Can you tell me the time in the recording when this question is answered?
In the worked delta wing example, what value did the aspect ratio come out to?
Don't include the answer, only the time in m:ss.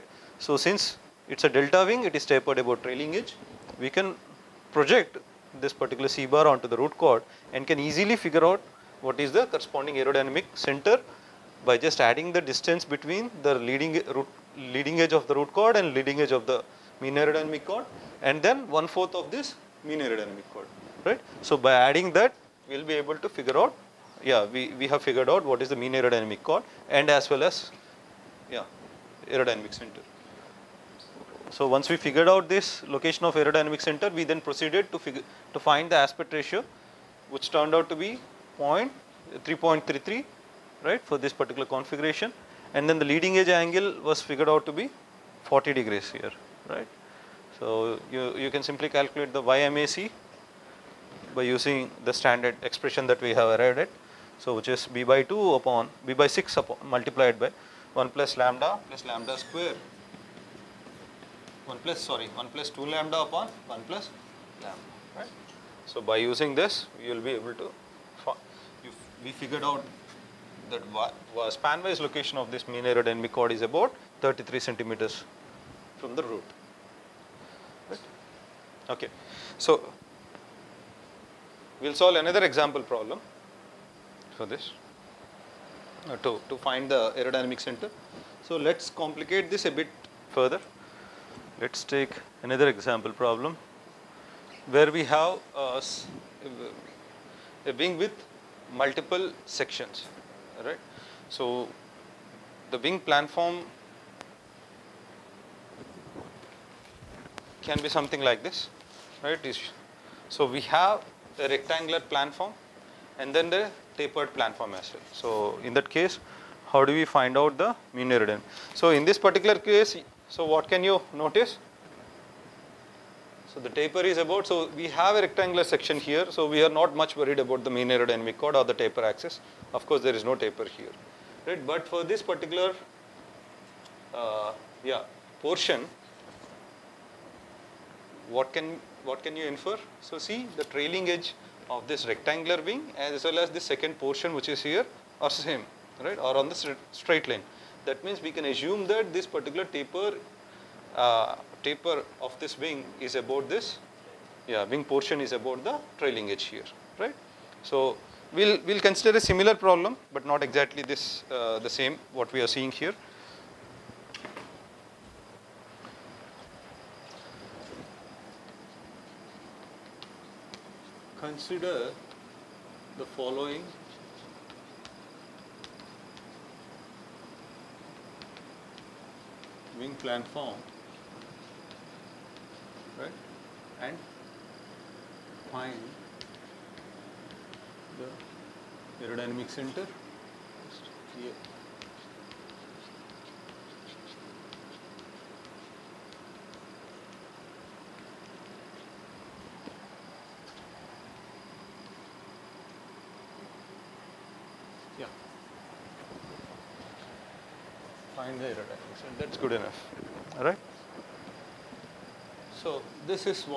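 0:38.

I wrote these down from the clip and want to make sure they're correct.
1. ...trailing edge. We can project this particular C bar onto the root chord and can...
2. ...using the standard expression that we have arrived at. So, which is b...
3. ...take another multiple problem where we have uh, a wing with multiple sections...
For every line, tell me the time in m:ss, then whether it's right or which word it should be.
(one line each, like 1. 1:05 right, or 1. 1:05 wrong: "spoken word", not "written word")
1. 0:02 right
2. 0:51 right
3. 1:31 wrong: "example", not "multiple".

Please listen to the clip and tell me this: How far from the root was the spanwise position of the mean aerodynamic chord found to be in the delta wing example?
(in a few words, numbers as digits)
33 centimeters.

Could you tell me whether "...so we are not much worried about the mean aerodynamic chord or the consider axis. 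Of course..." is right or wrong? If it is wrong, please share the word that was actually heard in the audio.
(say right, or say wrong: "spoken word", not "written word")
wrong: "taper", not "consider".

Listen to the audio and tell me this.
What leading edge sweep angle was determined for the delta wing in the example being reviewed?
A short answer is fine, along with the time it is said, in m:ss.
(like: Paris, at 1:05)
40 degrees, at 0:45.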